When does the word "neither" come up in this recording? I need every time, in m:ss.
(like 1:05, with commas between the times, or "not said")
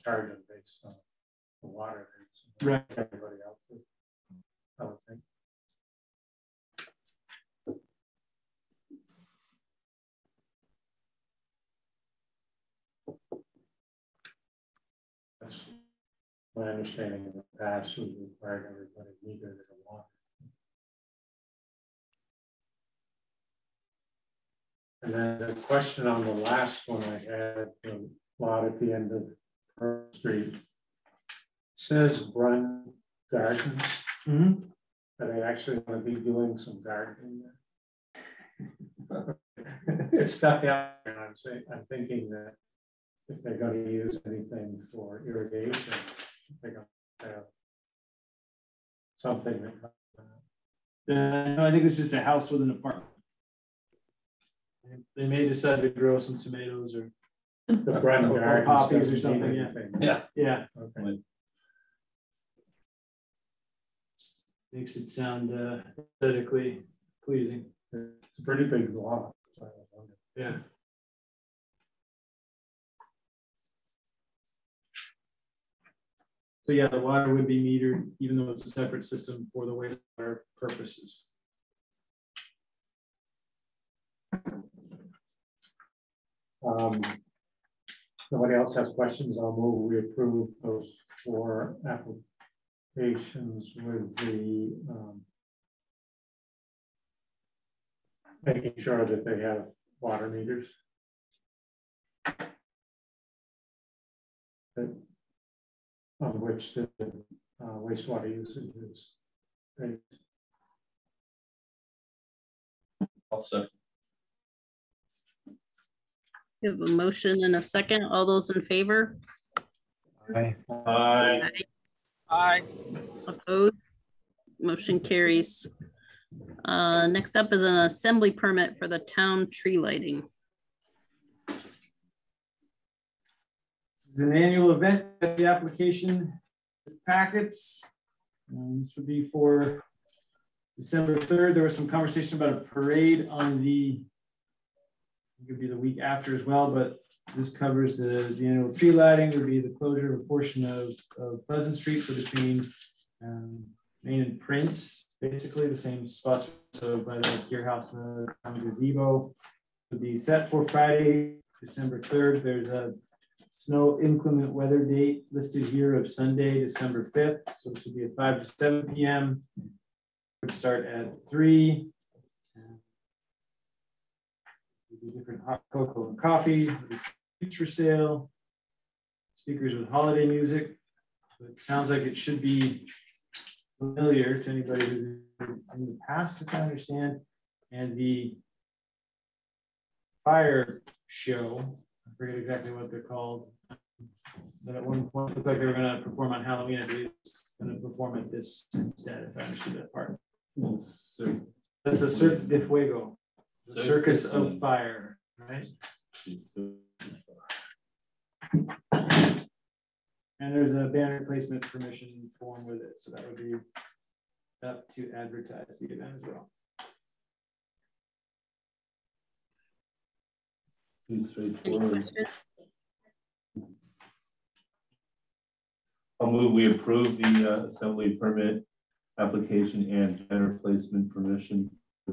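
0:19.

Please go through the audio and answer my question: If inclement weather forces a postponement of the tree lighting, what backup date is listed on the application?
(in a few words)
Sunday, December 5th.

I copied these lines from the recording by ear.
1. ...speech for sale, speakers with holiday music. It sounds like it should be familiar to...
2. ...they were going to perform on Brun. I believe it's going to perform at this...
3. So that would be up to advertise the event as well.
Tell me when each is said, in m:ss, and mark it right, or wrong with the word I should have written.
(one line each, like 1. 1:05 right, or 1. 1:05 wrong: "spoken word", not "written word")
1. 2:57 right
2. 3:15 wrong: "Halloween", not "Brun"
3. 3:32 right.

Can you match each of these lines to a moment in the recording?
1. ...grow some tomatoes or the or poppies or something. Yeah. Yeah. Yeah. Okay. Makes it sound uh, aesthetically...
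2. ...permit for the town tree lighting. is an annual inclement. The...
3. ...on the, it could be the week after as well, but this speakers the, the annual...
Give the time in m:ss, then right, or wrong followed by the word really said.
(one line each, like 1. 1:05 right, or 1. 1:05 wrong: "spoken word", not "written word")
1. 0:55 right
2. 2:08 wrong: "event", not "inclement"
3. 2:23 wrong: "covers", not "speakers".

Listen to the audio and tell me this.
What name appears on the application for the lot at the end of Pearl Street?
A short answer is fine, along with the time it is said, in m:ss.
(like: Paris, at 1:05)
Brun Gardens, at 0:32.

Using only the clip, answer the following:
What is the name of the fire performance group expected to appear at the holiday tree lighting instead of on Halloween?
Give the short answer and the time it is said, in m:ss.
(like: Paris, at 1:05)
Cirque de Fuego, at 3:22.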